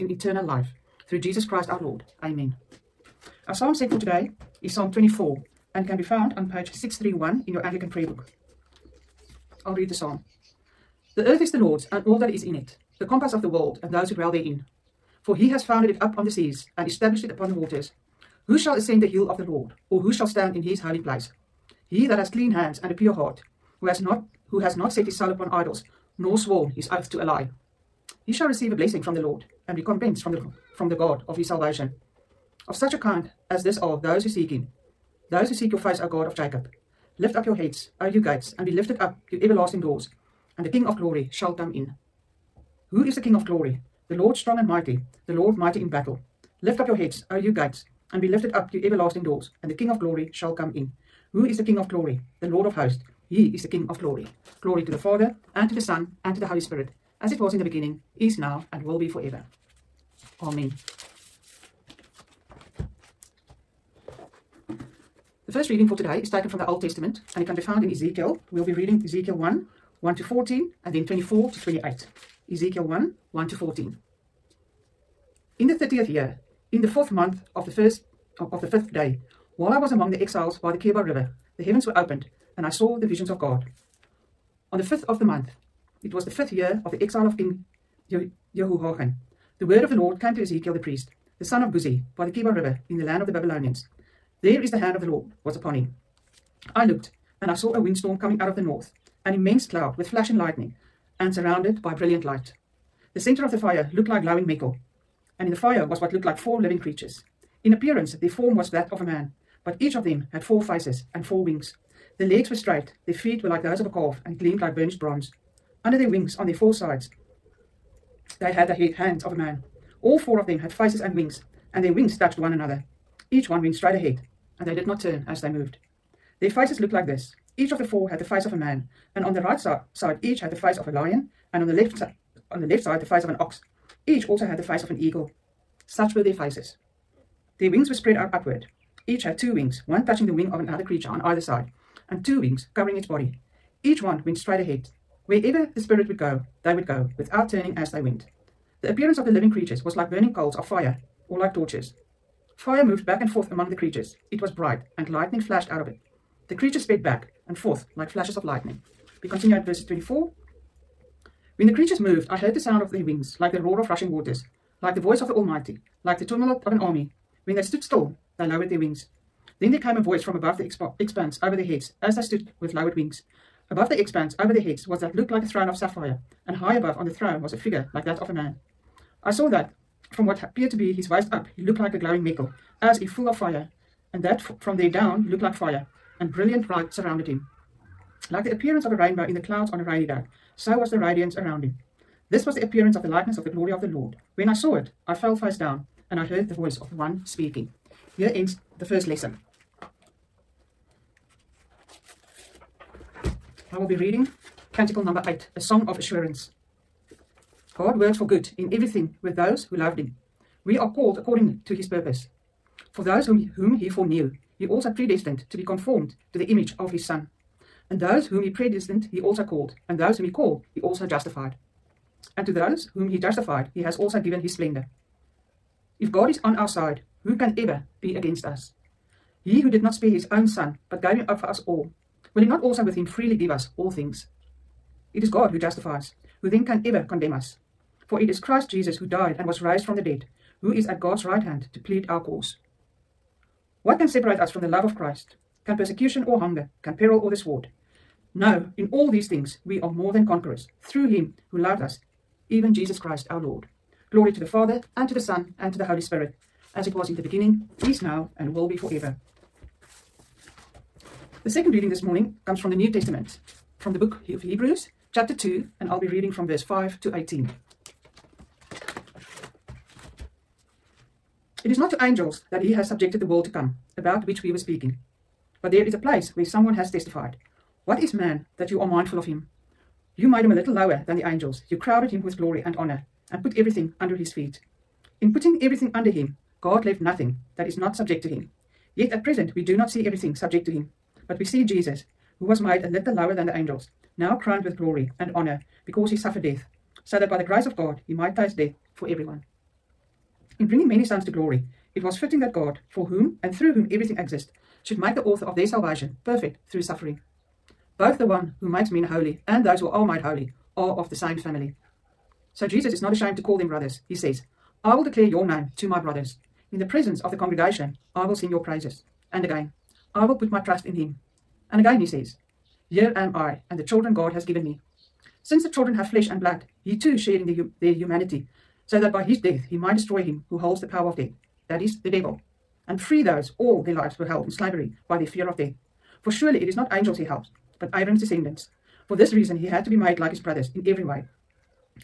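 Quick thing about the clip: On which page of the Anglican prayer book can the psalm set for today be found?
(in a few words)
631.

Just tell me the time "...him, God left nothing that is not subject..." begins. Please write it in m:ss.
4:46.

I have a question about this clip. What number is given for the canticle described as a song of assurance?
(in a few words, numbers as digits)
8.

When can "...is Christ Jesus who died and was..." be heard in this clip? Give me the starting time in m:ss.
3:58.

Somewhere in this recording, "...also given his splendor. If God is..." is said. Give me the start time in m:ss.
3:43.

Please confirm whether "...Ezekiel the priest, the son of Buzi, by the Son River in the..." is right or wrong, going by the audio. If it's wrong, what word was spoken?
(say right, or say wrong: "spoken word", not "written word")
wrong: "Kebar", not "Son".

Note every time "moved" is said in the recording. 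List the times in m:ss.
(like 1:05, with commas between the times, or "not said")
2:05, 2:32, 2:42.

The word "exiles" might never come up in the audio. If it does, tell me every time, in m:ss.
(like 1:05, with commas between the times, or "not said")
1:20, 1:27.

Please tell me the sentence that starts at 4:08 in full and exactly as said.
No, in all these things we are more than conquerors through him who loved us, even Jesus Christ our Lord.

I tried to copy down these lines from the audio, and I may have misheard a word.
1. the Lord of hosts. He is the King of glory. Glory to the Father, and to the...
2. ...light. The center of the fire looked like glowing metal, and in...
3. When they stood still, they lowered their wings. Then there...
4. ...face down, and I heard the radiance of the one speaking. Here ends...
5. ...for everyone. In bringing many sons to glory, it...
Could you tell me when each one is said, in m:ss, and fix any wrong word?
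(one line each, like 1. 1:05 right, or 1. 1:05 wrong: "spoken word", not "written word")
1. 0:52 right
2. 1:42 right
3. 2:47 right
4. 3:15 wrong: "voice", not "radiance"
5. 4:58 right.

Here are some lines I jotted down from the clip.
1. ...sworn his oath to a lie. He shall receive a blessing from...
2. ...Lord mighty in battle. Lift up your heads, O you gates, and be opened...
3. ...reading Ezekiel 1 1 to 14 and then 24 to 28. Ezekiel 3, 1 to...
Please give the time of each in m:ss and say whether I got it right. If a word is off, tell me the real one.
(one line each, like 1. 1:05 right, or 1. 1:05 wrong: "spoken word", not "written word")
1. 0:26 right
2. 0:45 wrong: "lifted", not "opened"
3. 1:08 wrong: "1", not "3".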